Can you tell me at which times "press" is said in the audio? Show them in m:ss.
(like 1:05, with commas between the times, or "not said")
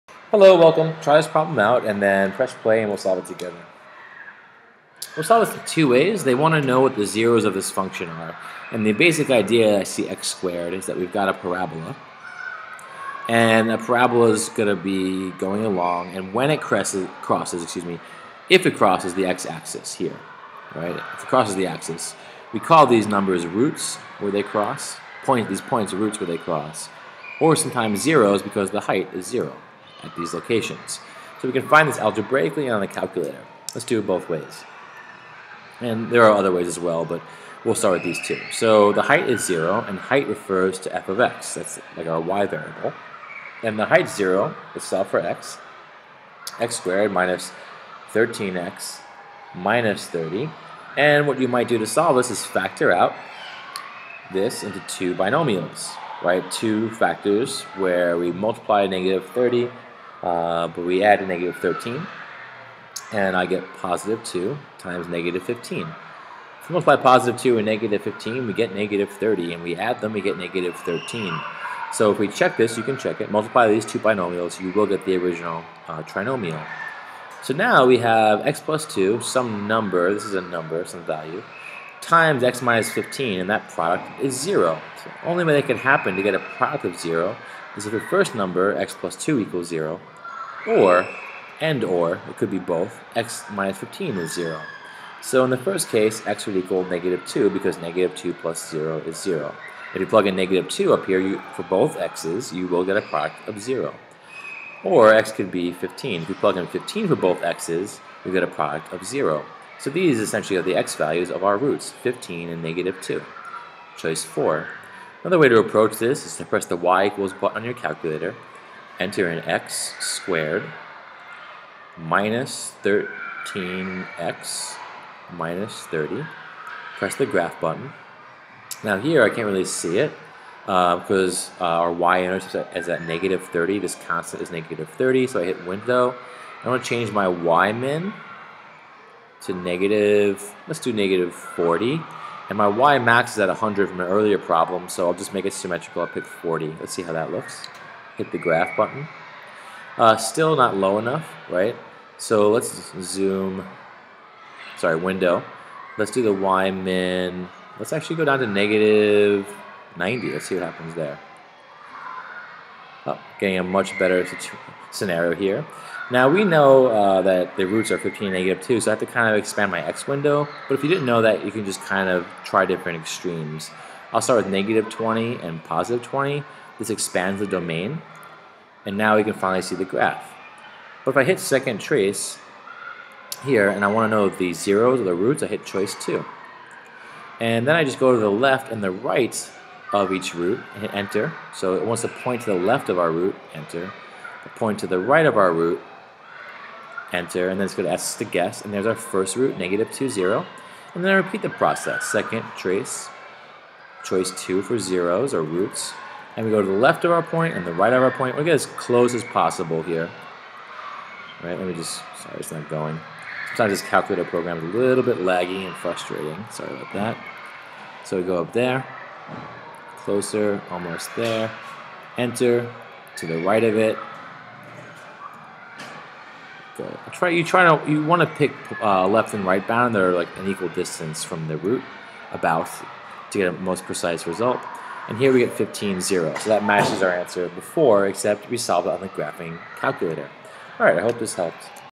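0:02, 1:56, 2:06.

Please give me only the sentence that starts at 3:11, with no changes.
So it wants to point to the left of our root, enter.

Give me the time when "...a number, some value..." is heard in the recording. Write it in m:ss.
1:20.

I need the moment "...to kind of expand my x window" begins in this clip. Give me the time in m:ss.
2:48.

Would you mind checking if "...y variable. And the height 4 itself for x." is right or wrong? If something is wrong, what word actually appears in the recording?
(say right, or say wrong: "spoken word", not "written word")
wrong: "0", not "4".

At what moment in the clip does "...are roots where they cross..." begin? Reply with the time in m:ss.
0:25.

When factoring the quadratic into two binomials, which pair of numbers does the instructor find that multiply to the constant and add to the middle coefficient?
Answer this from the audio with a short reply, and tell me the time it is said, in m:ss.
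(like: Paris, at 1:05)
2 and -15, at 1:03.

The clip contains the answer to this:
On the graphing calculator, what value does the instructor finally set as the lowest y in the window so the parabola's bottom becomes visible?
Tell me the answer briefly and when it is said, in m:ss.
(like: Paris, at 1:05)
-90, at 2:38.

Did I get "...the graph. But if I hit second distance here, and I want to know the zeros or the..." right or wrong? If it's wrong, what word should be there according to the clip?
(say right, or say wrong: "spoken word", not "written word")
wrong: "trace", not "distance".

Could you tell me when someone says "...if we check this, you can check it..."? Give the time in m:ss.
1:12.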